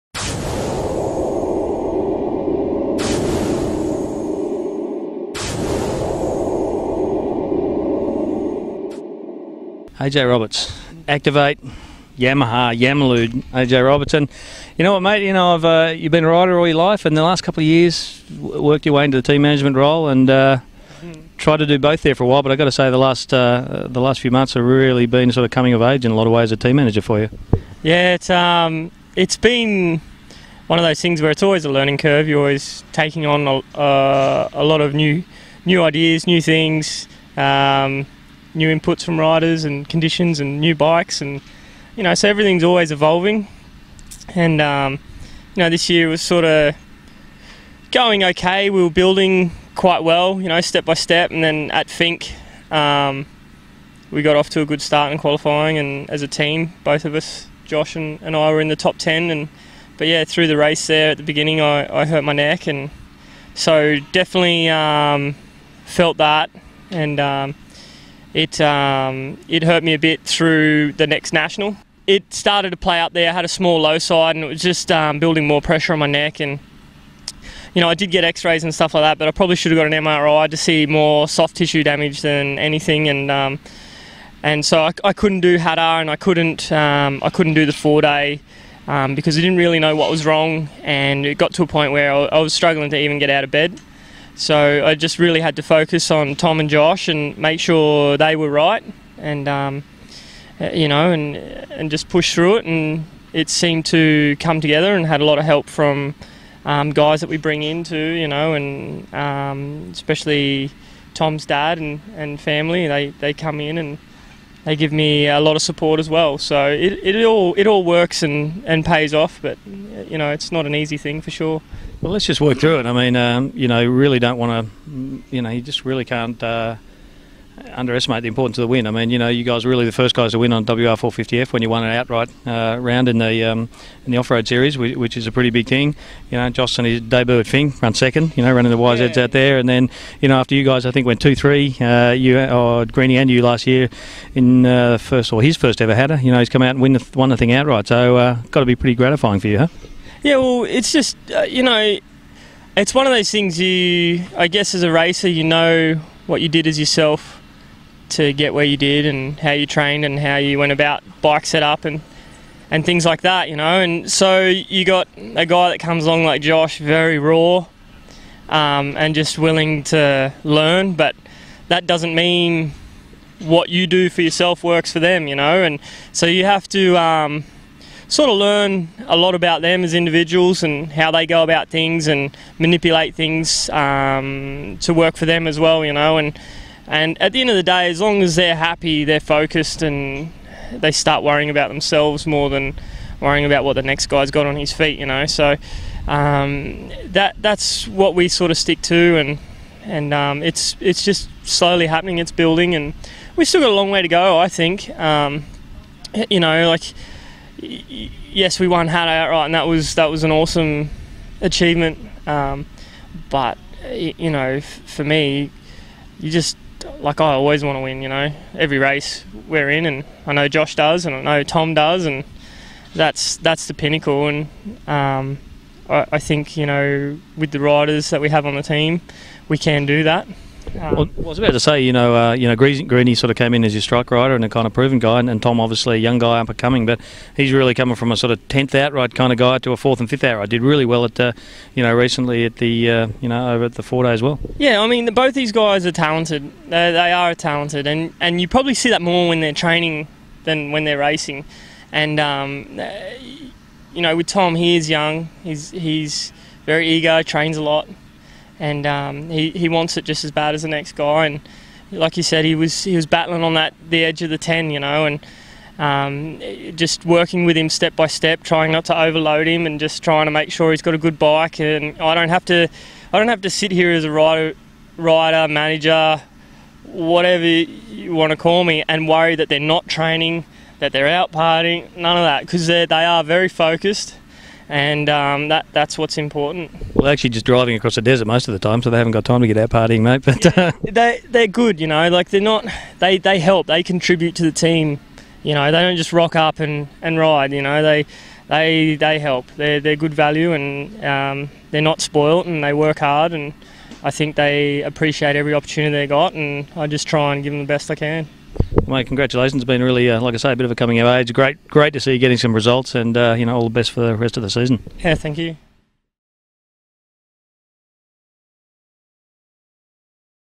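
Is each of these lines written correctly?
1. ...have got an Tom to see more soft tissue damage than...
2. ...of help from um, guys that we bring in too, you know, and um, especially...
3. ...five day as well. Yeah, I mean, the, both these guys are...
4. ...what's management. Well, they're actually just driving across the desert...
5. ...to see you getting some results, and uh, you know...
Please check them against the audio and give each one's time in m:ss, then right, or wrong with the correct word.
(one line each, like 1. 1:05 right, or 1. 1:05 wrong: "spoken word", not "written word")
1. 1:19 wrong: "MRI", not "Tom"
2. 1:45 right
3. 4:03 wrong: "four", not "five"
4. 4:45 wrong: "important", not "management"
5. 5:11 right.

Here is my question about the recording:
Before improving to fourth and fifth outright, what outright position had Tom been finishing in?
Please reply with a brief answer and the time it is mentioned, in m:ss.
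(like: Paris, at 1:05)
Tenth, at 3:58.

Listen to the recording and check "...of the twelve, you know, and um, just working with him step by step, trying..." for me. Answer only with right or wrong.
wrong.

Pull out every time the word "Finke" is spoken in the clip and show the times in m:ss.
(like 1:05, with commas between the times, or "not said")
0:51, 2:17.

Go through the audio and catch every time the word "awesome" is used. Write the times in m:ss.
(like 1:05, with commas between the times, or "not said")
3:30.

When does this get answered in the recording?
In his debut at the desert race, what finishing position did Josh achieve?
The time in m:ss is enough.
2:17.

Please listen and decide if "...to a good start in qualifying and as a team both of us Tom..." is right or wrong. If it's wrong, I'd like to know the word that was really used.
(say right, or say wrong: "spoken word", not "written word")
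wrong: "Josh", not "Tom".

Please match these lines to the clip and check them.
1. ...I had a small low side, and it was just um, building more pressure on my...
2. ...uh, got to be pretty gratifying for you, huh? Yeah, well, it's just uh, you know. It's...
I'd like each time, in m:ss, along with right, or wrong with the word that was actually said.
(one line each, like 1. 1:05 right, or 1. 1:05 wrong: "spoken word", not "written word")
1. 1:13 right
2. 2:28 right.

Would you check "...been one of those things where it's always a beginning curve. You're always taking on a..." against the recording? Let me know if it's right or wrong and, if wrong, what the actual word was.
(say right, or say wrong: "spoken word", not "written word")
wrong: "learning", not "beginning".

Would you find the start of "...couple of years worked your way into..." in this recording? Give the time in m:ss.
0:17.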